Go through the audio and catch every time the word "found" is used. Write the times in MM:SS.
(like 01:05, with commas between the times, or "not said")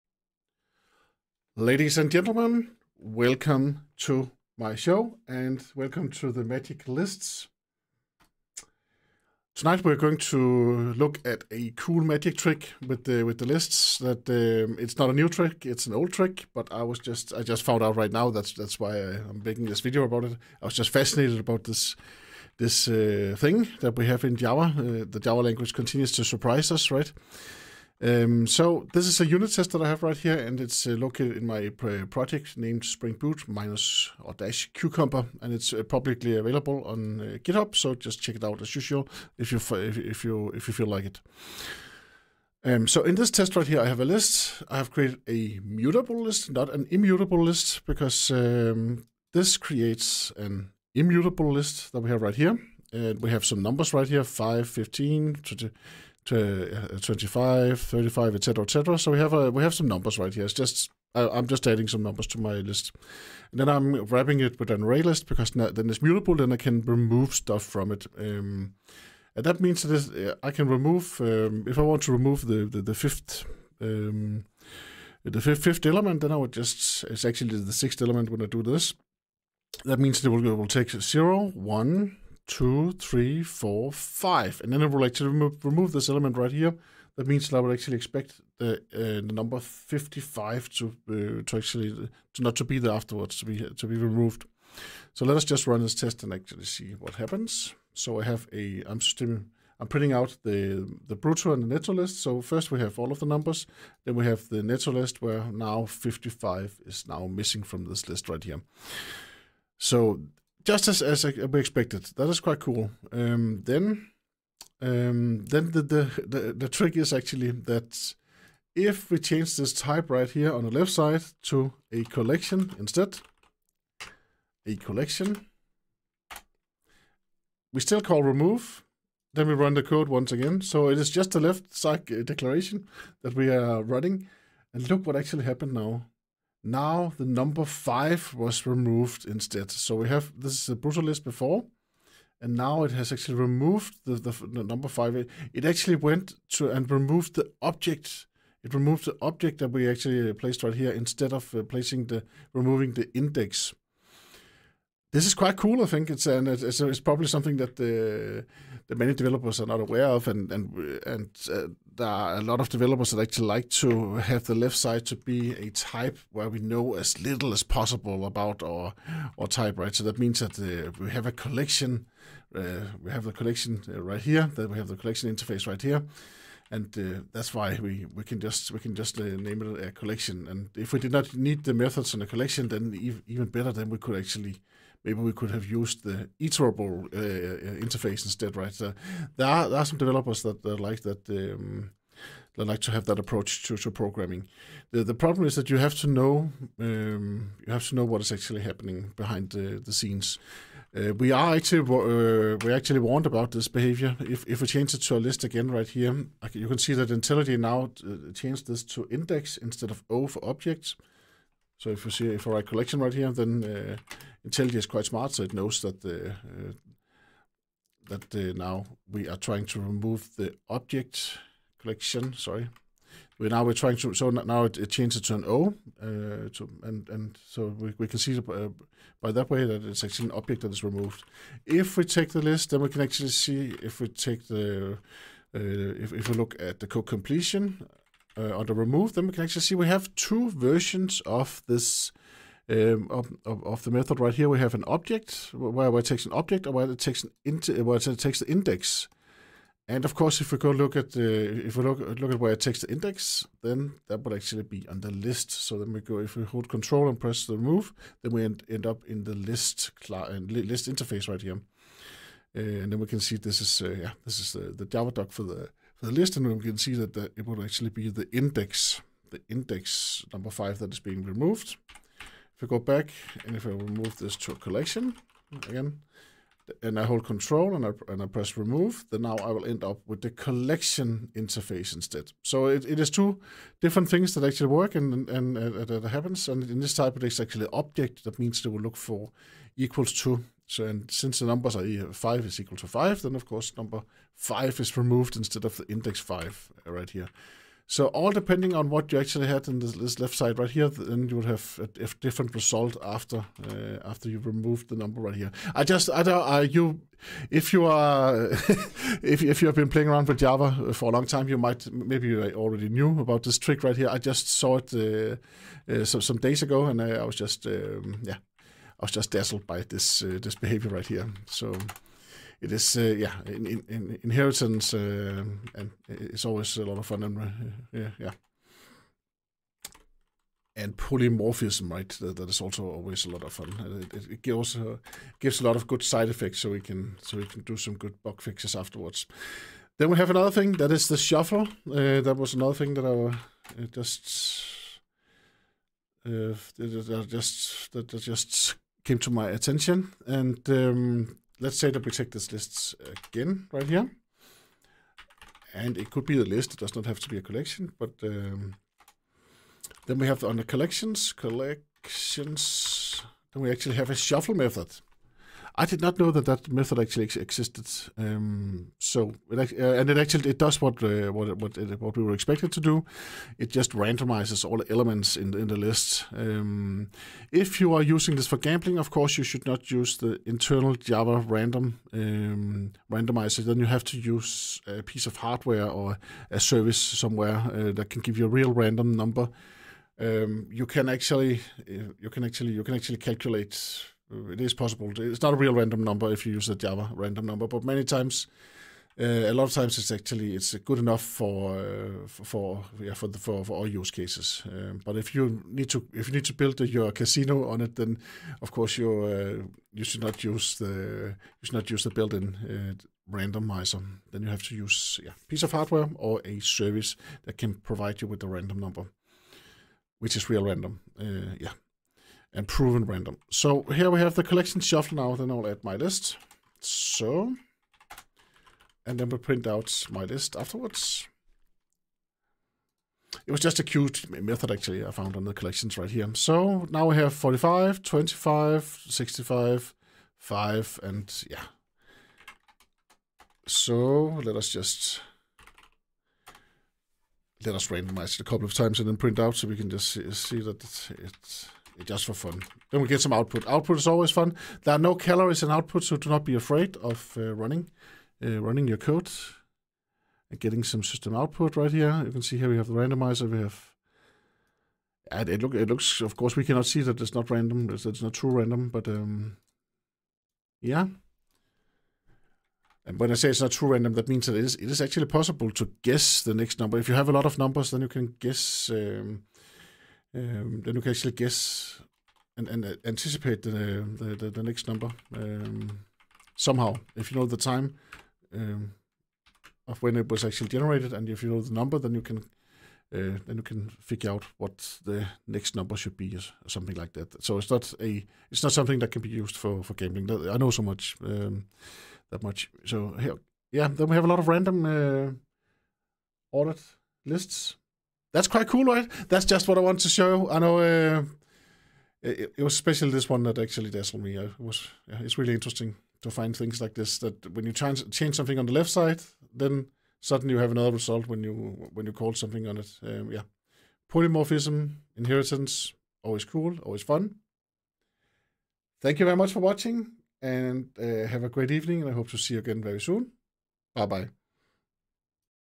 00:17, 07:15.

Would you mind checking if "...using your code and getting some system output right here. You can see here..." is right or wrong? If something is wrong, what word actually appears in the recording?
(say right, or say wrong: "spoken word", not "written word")
wrong: "running", not "using".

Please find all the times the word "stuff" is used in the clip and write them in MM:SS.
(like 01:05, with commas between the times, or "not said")
01:07.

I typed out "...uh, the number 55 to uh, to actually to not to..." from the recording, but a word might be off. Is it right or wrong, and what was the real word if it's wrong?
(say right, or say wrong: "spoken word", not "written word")
right.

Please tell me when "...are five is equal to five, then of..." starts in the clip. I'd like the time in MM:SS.
04:51.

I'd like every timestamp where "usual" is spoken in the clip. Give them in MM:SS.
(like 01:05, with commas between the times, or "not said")
00:38.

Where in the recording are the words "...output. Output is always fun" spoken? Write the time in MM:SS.
07:33.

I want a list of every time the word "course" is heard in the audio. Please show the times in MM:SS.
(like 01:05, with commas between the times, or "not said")
04:10, 04:53, 06:19, 06:48, 07:46.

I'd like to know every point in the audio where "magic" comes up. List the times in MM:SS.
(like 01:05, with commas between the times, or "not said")
00:06, 00:12.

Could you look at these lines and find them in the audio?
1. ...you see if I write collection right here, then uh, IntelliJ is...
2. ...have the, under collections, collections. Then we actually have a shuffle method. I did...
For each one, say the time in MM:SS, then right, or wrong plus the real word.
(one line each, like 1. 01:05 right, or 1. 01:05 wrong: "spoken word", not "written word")
1. 03:32 right
2. 06:00 right.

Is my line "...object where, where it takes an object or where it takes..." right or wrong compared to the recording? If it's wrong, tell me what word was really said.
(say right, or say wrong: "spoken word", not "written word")
right.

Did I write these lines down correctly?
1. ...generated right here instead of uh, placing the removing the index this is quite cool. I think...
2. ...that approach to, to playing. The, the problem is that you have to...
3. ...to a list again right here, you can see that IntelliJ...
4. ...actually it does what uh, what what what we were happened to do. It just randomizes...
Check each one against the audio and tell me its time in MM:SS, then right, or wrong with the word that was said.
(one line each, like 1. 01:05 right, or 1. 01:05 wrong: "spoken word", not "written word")
1. 02:30 wrong: "placed", not "generated"
2. 03:13 wrong: "programming", not "playing"
3. 03:24 right
4. 06:10 wrong: "expected", not "happened".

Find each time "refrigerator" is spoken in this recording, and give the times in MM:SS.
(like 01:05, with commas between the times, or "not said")
not said.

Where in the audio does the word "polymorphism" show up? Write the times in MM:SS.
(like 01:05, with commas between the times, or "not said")
05:30, 08:44.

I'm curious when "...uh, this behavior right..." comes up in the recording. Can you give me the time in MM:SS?
05:20.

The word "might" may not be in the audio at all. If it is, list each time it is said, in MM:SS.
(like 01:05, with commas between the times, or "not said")
05:11.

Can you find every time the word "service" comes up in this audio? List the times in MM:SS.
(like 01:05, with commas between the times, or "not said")
06:26, 06:56.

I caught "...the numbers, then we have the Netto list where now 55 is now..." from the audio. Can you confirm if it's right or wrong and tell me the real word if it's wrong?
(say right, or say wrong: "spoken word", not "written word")
right.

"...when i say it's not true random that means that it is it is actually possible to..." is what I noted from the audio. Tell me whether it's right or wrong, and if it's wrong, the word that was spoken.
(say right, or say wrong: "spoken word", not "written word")
right.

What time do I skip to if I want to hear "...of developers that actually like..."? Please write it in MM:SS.
02:42.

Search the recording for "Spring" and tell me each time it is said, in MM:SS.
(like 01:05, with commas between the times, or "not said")
00:32.